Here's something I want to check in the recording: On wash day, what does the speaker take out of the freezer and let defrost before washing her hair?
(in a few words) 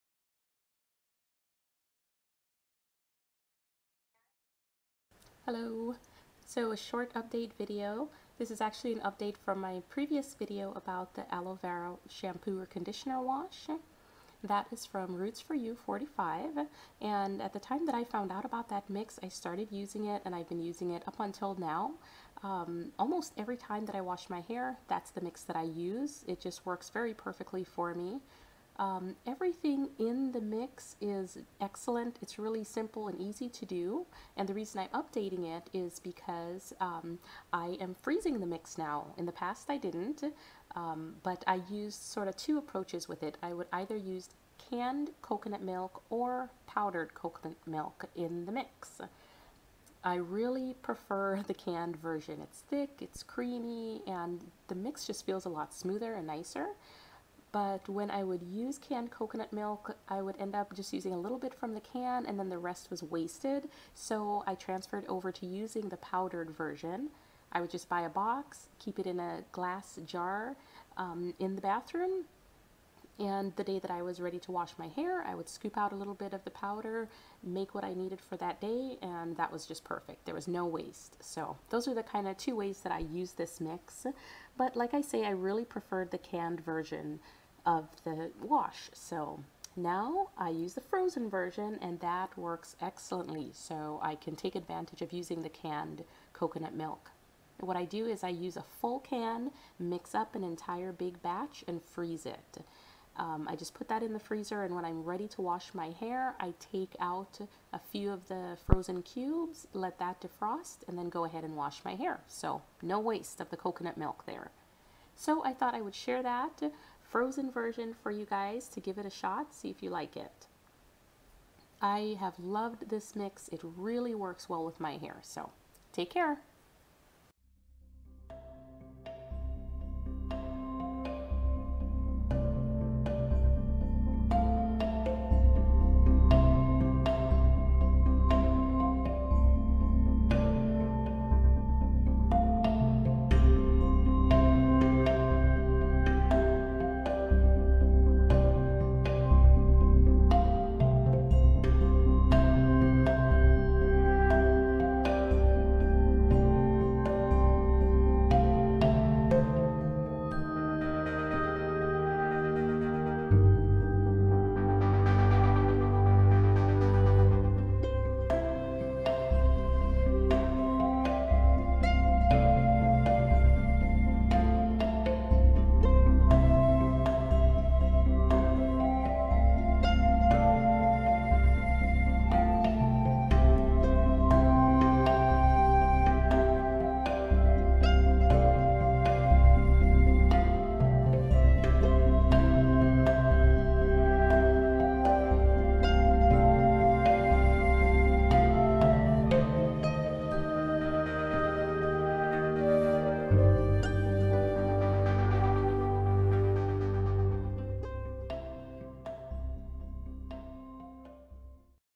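frozen cubes.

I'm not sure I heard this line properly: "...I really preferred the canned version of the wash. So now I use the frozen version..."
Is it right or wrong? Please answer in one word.
right.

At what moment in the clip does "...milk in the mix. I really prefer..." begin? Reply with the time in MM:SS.
00:47.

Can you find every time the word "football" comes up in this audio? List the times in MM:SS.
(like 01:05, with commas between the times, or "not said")
not said.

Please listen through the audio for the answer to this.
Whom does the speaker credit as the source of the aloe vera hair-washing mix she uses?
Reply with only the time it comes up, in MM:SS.
00:15.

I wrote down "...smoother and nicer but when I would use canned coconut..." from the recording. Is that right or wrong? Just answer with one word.
right.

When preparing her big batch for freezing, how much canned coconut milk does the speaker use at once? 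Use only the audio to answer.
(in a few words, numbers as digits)
a full can.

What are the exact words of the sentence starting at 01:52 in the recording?
So no waste of the coconut milk there.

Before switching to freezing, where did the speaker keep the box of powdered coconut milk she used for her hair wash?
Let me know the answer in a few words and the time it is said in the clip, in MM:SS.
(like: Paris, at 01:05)
glass jar, at 01:09.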